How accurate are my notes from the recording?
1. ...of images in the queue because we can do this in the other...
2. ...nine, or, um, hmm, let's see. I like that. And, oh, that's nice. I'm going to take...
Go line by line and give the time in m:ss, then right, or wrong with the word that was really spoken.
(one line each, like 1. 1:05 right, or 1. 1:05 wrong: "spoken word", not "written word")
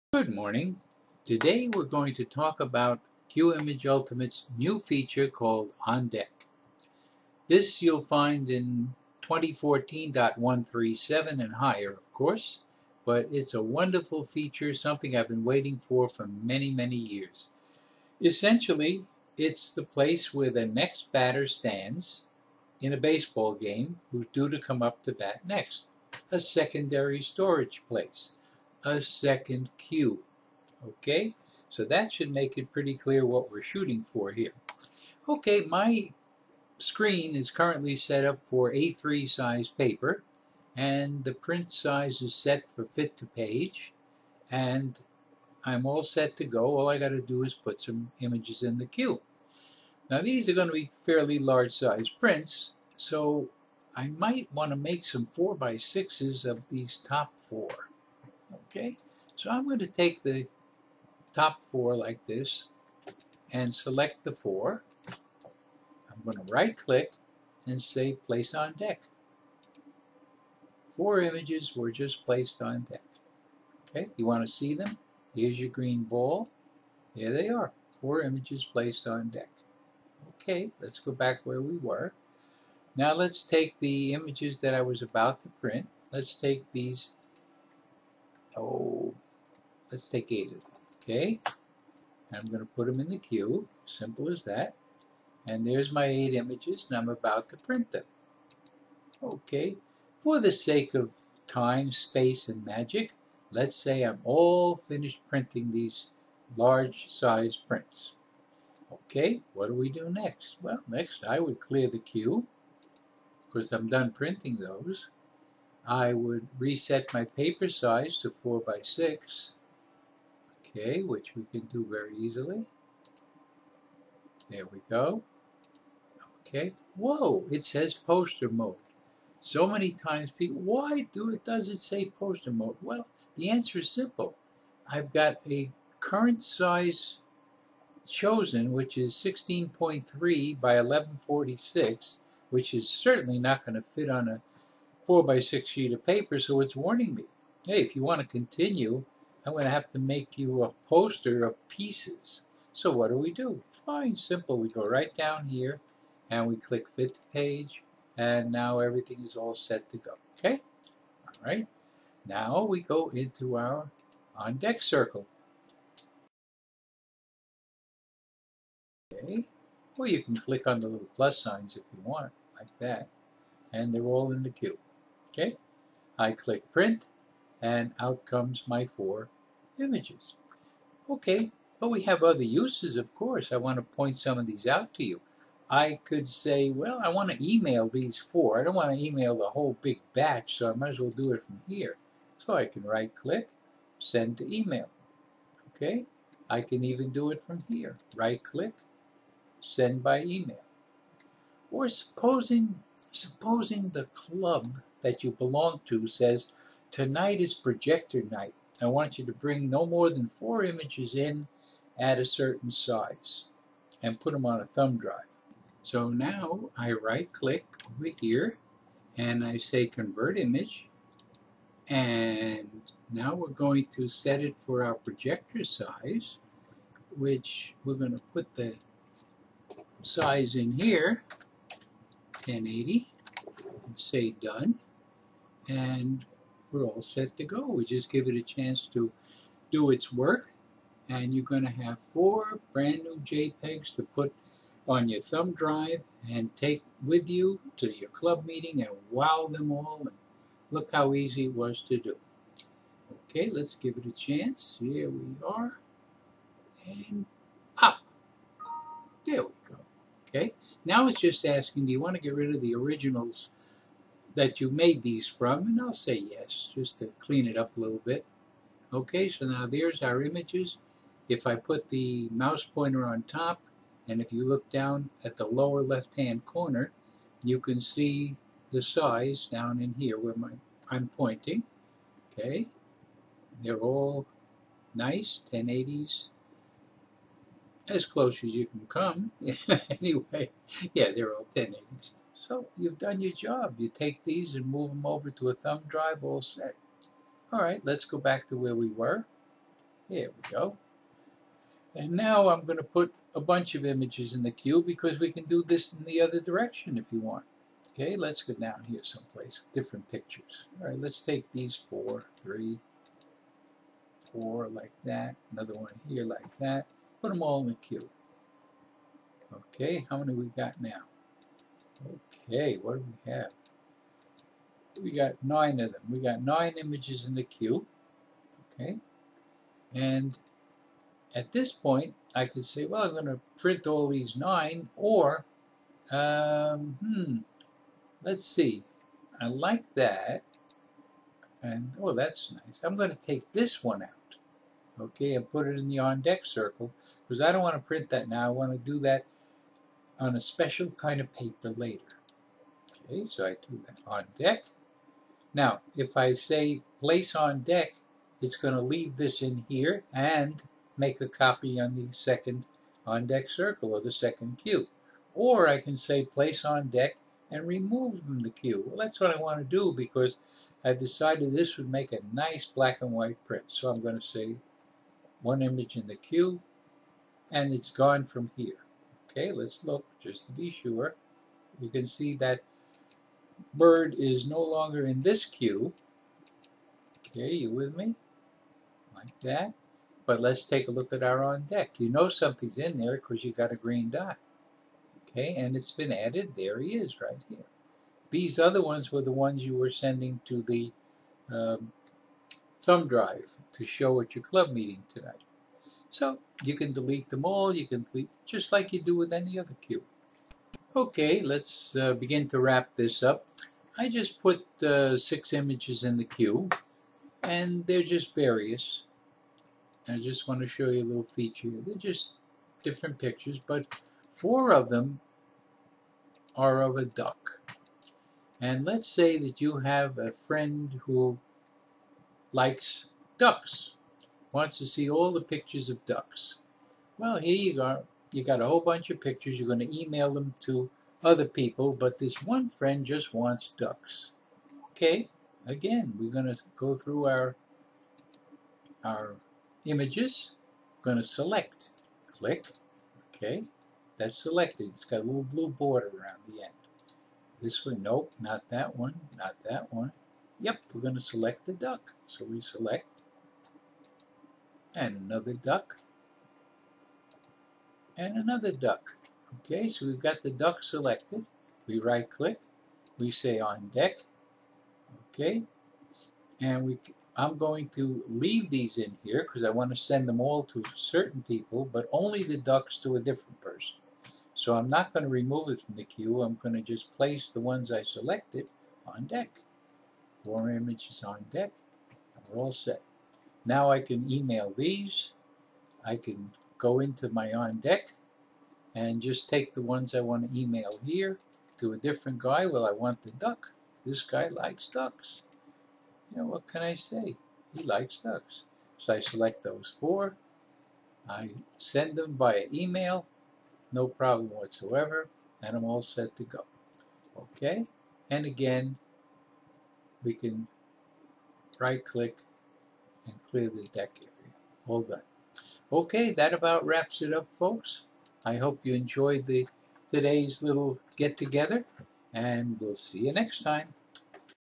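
1. 5:03 right
2. 5:34 right.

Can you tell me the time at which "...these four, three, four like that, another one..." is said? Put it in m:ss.
5:11.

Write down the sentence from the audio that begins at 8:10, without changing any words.
Four images on deck, and we're all set.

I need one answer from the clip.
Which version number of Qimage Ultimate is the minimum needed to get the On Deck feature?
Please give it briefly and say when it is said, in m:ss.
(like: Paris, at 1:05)
2014.137, at 0:09.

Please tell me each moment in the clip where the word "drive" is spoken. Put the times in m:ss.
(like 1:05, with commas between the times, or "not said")
3:34, 4:05, 4:55, 6:43.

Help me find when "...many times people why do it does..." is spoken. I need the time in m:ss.
2:09.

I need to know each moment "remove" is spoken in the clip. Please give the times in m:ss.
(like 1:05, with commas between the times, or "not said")
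6:07, 8:05.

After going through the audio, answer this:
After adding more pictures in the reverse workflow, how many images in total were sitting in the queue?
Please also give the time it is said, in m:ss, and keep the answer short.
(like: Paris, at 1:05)
9, at 5:26.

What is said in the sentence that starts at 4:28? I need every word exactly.
Okay, so now there's our images.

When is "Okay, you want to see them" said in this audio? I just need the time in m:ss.
1:13.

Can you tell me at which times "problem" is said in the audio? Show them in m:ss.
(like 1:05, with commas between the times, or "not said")
8:34.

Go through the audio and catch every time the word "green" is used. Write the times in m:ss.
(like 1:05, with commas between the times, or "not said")
1:15, 6:33.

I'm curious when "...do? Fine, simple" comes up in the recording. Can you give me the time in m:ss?
2:33.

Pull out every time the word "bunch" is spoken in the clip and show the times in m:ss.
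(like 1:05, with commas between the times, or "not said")
5:03, 7:18.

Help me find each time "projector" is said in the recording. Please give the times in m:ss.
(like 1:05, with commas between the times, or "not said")
3:27, 3:44.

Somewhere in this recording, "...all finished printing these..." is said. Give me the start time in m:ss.
1:44.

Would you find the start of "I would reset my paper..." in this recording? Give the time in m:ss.
1:55.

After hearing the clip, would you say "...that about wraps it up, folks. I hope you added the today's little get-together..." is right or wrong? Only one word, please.
wrong.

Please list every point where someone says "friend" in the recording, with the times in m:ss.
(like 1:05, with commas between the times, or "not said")
7:10, 7:22.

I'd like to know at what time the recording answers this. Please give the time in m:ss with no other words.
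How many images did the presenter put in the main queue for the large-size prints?
1:30.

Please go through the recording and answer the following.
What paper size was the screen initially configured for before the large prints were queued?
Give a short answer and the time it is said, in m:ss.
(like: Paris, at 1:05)
A3, at 0:38.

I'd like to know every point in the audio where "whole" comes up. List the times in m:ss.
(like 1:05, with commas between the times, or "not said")
3:09, 7:18.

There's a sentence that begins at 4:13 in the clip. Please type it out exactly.
Okay, let's give it a chance.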